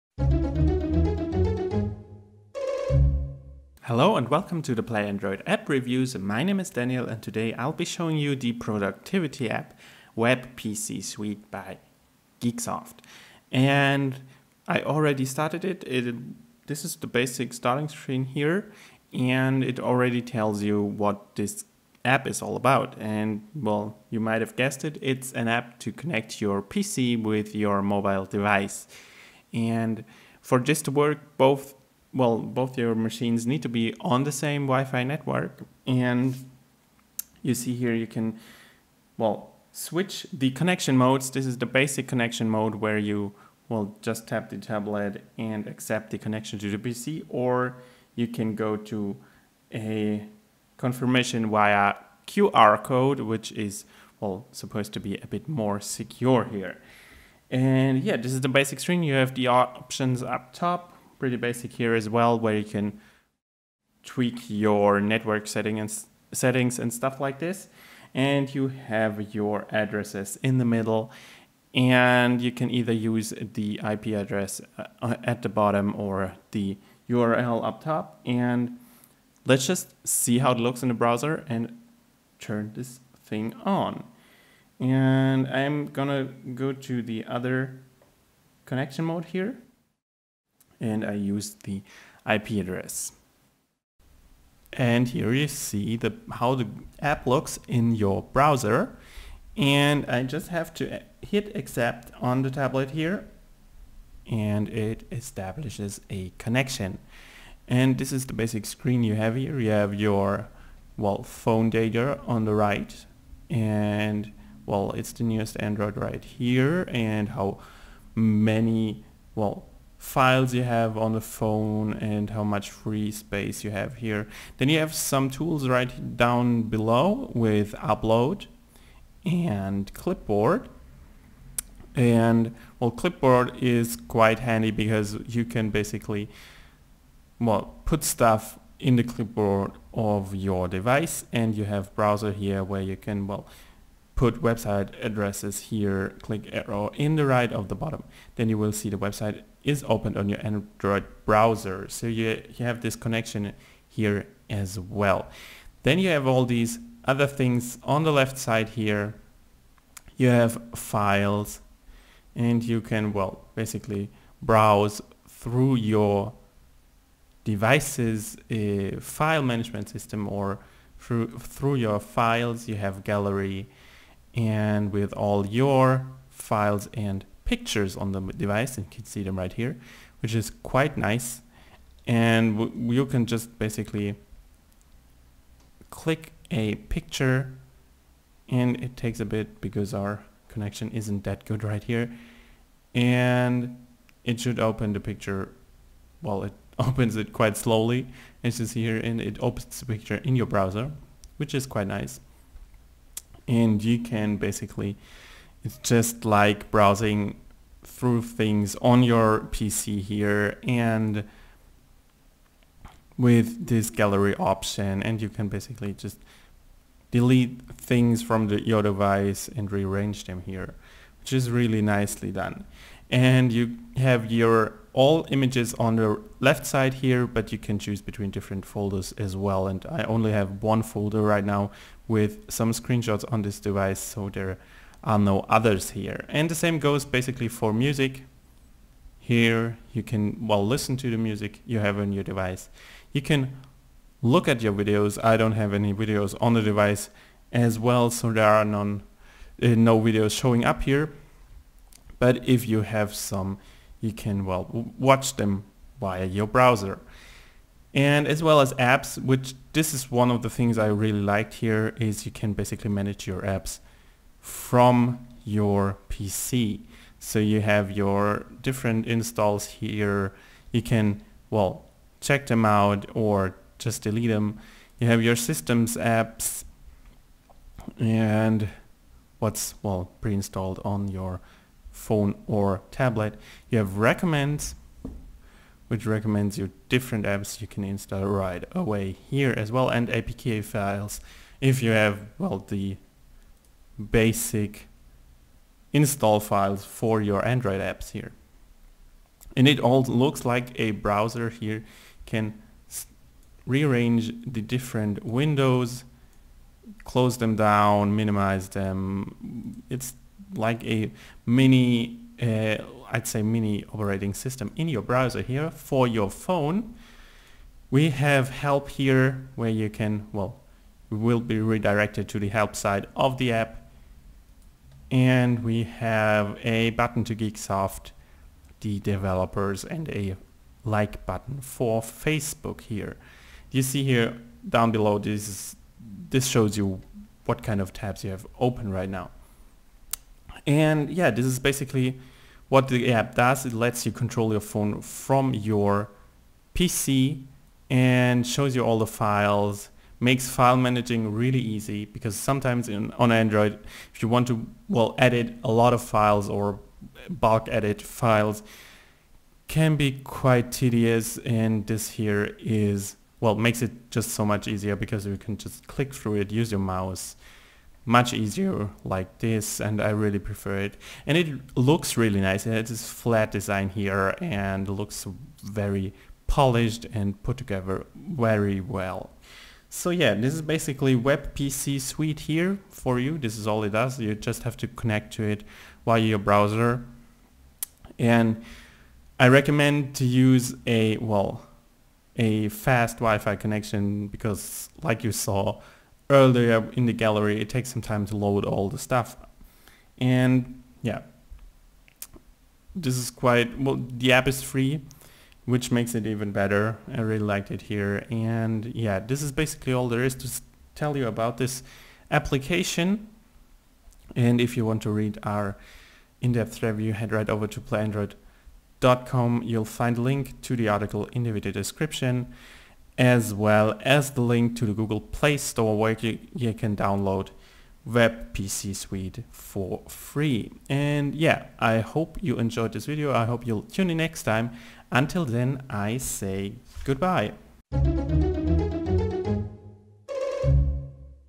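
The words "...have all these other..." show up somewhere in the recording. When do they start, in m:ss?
2:36.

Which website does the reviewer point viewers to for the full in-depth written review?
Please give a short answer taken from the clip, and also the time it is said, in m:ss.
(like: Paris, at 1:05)
playandroid.com, at 6:57.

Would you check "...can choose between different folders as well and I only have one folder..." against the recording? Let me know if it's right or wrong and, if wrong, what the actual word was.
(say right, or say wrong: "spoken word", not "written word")
right.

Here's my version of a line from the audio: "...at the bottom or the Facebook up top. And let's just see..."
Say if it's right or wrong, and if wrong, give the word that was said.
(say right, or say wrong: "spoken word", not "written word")
wrong: "URL", not "Facebook".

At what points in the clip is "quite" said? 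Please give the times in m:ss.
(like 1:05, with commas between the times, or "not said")
2:13, 3:00, 3:17, 3:21, 6:00, 6:43.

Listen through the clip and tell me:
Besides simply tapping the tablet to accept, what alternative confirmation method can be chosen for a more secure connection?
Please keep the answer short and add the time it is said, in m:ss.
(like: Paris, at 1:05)
QR code, at 0:52.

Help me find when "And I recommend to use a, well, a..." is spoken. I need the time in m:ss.
6:28.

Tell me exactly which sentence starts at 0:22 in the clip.
And well, you might have guessed it, it's an app to connect your PC with your mobile device.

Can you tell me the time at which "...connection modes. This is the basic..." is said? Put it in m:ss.
0:40.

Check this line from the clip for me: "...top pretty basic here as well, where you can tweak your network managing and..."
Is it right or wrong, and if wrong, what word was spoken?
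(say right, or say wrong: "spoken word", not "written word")
wrong: "setting", not "managing".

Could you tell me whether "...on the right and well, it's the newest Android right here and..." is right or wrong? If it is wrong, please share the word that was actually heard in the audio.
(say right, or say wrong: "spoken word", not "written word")
right.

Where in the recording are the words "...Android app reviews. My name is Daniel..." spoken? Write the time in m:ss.
0:05.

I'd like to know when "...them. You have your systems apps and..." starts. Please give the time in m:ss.
4:34.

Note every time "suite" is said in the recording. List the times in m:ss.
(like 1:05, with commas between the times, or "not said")
0:11, 6:21, 7:08.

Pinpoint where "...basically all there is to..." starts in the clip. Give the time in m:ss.
6:49.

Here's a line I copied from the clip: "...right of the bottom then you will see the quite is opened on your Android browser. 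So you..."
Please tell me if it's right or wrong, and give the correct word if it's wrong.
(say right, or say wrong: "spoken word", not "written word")
wrong: "website", not "quite".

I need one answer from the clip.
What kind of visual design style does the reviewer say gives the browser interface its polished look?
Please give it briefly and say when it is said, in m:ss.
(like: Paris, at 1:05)
flat design, at 6:13.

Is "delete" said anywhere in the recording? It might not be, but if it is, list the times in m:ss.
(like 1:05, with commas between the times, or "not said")
3:37, 4:34.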